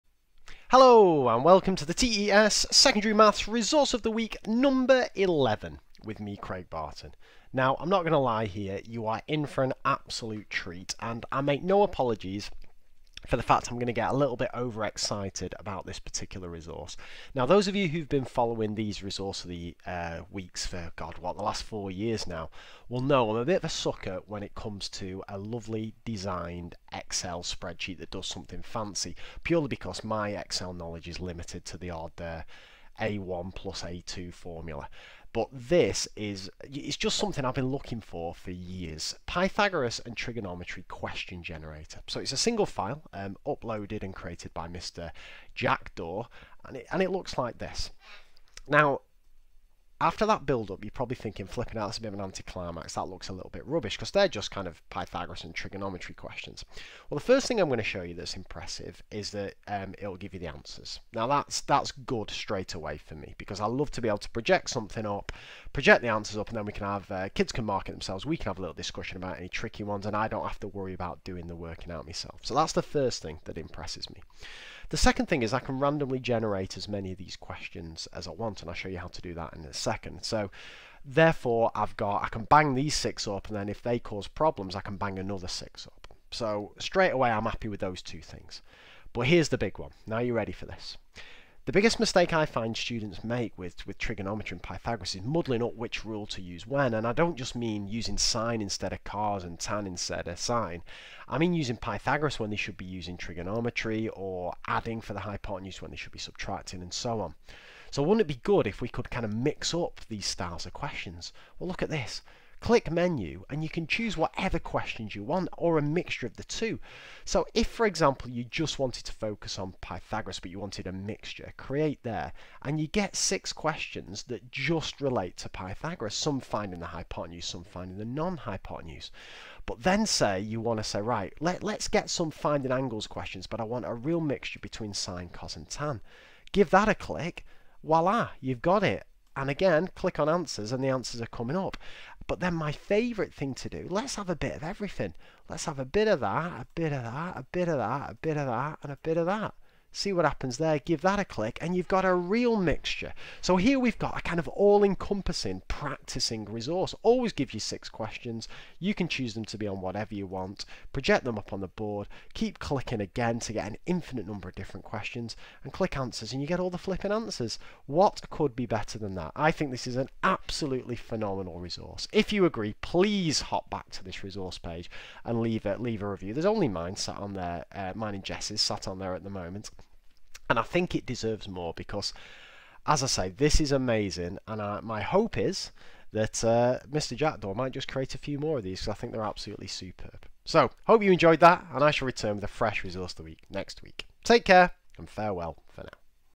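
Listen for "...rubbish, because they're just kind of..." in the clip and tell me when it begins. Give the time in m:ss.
0:53.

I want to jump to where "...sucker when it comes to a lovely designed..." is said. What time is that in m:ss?
0:23.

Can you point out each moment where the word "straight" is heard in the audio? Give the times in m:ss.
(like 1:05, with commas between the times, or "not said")
1:02, 1:26.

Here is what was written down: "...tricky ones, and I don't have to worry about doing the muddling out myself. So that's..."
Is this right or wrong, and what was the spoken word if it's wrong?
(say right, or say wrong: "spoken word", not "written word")
wrong: "working", not "muddling".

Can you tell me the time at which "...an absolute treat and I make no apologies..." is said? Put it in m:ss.
0:09.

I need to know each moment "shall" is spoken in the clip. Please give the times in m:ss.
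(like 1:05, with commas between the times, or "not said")
3:11.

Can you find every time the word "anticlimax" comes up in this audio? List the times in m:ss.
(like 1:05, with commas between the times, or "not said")
0:52.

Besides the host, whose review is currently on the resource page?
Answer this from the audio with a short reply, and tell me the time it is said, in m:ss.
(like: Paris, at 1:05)
Jess, at 2:58.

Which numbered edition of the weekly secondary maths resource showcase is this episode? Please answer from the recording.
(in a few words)
11.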